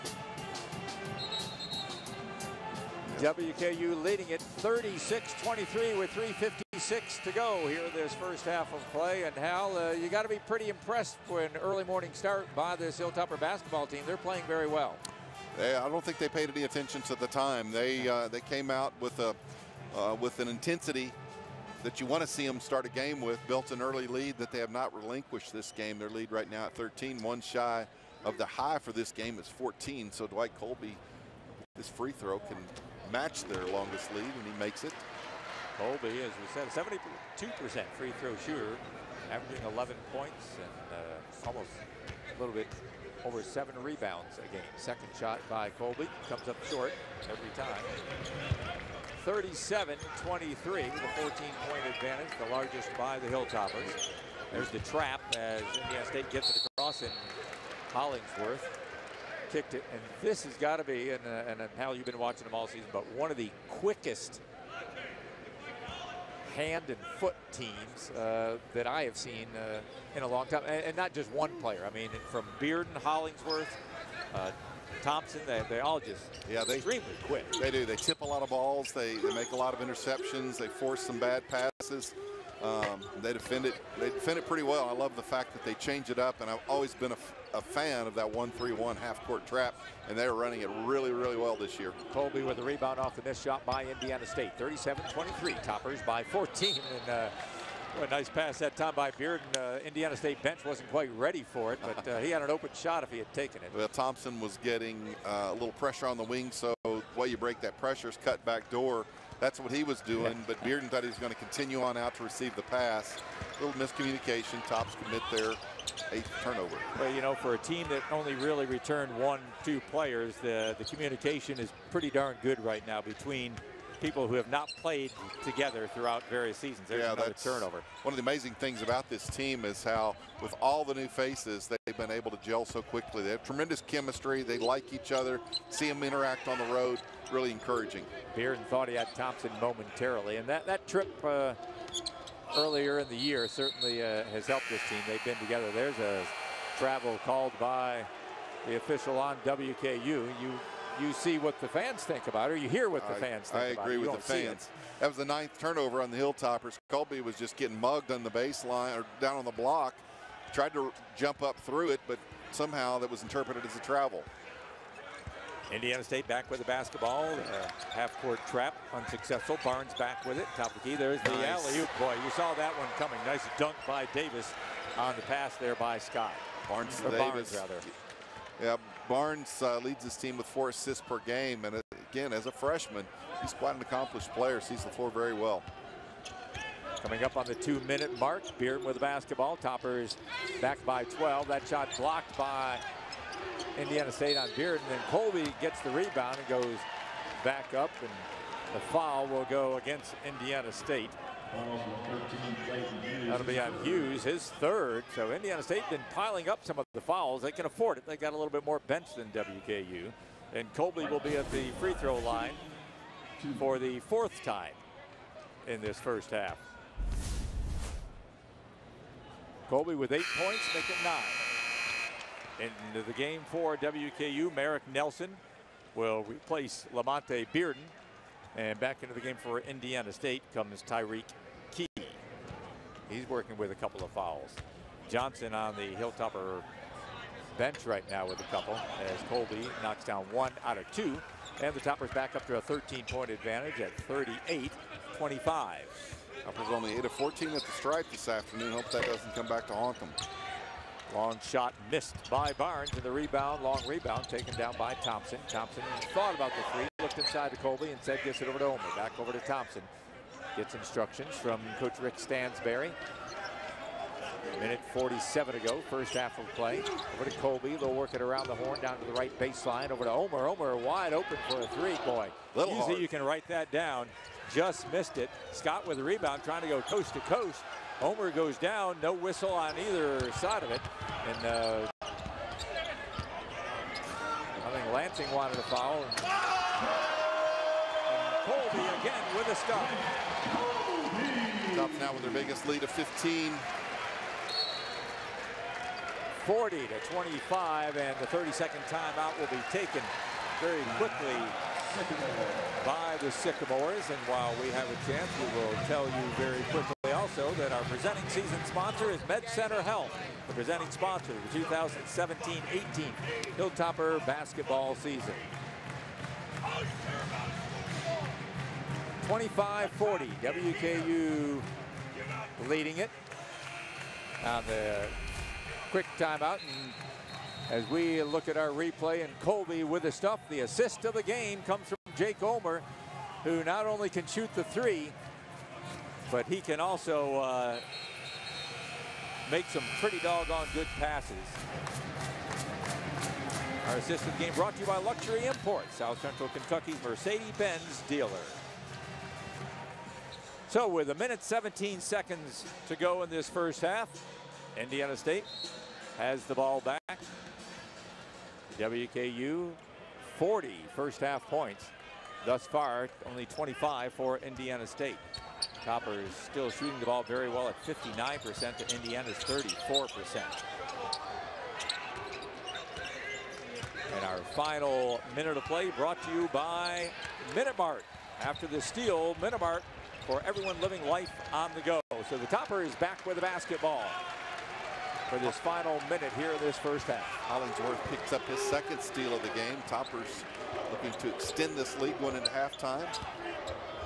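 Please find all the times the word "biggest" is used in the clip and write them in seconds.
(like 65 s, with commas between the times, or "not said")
292 s.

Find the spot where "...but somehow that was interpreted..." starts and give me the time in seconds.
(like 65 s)
162 s.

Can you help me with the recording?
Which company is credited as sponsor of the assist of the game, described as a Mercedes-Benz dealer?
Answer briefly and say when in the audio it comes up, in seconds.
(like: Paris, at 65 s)
Luxury Imports, at 344 s.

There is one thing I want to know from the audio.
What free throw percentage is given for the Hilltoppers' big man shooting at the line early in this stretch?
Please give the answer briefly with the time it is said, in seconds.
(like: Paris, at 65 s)
72%, at 36 s.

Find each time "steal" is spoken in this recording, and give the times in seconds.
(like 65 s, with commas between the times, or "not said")
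378 s, 389 s.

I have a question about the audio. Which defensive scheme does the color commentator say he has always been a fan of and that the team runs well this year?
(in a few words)
1-3-1 half-court trap.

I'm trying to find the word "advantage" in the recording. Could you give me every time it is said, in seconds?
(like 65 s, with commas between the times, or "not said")
51 s, 243 s.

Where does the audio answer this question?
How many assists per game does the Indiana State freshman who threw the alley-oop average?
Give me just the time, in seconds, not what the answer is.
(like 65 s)
180 s.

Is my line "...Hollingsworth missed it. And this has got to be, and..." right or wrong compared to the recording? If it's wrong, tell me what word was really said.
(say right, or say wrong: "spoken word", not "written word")
wrong: "kicked", not "missed".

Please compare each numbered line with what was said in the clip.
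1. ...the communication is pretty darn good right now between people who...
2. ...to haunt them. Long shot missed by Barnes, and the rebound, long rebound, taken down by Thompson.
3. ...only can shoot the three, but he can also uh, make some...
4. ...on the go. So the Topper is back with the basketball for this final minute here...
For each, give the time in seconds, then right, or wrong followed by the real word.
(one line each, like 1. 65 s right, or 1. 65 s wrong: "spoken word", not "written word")
1. 120 s right
2. 249 s right
3. 333 s right
4. 381 s right.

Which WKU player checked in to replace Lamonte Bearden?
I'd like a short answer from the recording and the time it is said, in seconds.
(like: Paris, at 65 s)
Merrick Nelson, at 224 s.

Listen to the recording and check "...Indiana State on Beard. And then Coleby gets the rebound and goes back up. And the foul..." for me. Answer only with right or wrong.
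right.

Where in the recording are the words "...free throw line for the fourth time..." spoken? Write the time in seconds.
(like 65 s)
211 s.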